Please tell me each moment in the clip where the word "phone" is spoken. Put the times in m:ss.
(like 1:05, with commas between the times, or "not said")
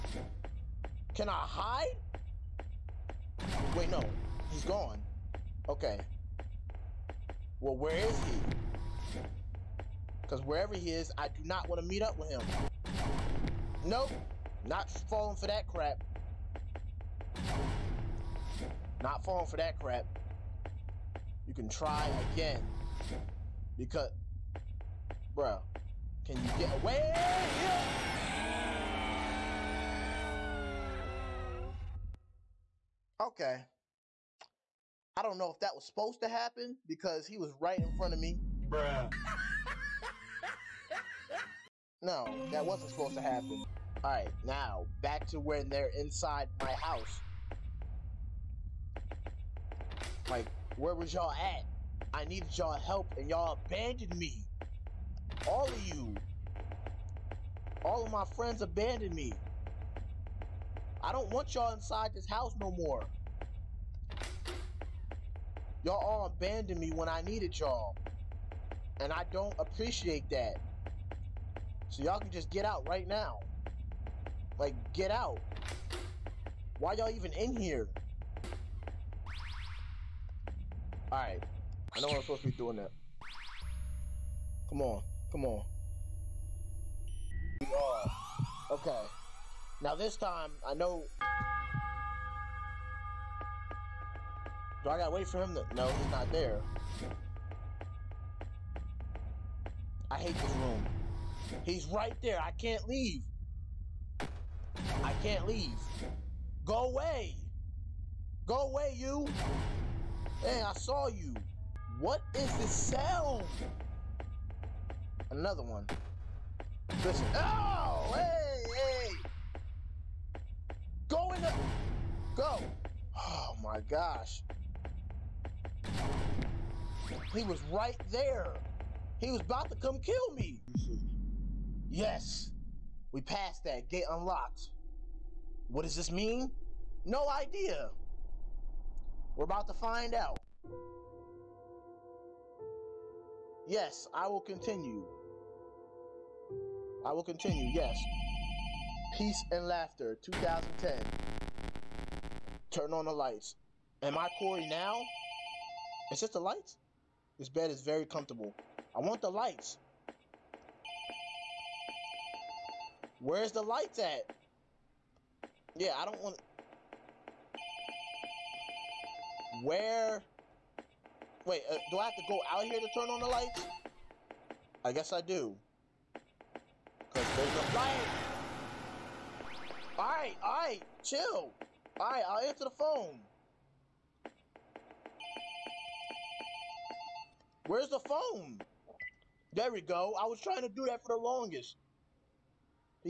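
3:02, 3:07.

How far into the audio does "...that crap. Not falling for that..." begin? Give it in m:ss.
0:15.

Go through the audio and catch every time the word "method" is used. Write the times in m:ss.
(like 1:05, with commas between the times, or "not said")
not said.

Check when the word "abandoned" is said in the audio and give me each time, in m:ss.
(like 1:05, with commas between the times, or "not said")
0:53, 0:58, 1:06.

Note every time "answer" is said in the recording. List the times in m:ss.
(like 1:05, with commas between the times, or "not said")
3:02.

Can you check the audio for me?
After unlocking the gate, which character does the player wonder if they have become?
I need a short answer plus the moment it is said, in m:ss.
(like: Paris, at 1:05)
Cory, at 2:34.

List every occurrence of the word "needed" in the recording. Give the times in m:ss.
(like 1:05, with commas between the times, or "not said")
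0:52, 1:07.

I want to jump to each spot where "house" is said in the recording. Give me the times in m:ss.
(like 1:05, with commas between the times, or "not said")
0:46, 1:02.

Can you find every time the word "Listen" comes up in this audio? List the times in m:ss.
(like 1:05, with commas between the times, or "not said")
1:57.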